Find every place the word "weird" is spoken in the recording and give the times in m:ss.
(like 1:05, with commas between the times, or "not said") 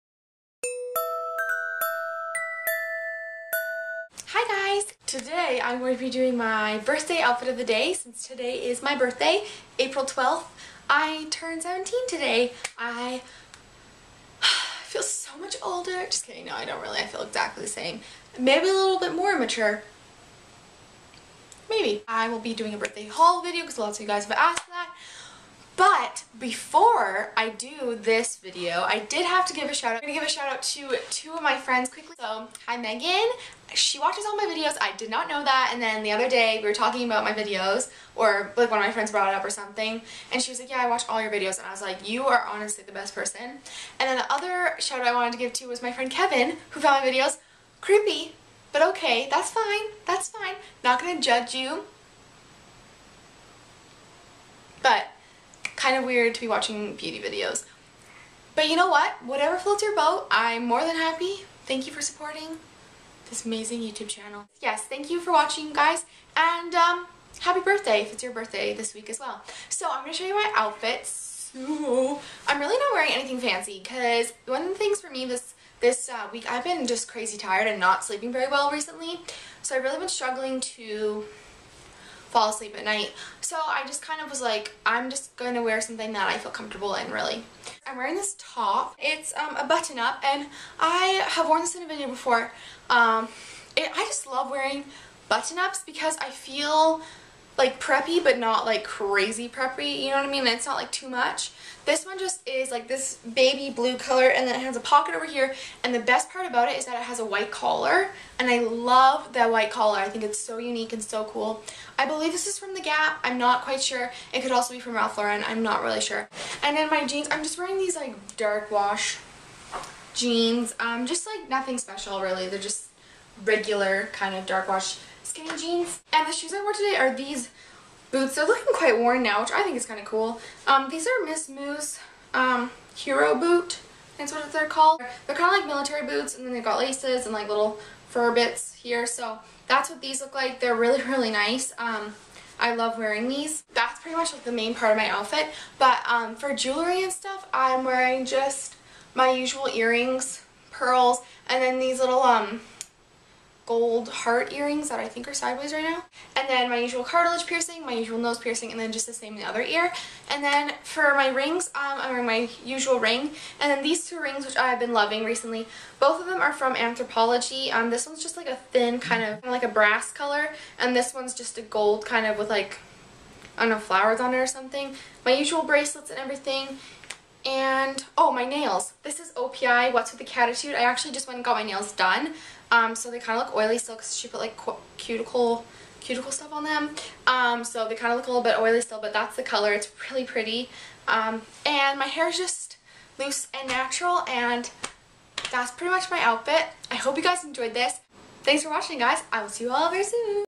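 0:56.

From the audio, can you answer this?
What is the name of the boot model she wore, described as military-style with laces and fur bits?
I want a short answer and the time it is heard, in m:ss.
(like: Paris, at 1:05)
Hero Boot, at 2:12.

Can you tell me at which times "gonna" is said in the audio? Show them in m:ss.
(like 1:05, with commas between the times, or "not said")
0:30, 0:51.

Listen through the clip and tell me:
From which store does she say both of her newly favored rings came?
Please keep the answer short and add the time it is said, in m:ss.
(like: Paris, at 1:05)
Anthropologie, at 2:46.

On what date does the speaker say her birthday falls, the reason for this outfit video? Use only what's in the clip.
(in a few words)
April 12th.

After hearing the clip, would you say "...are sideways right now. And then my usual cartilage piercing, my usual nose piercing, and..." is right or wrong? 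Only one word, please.
right.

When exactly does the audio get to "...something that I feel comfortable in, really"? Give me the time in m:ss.
1:25.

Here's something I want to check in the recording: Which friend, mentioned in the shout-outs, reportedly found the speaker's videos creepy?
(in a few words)
Kevin.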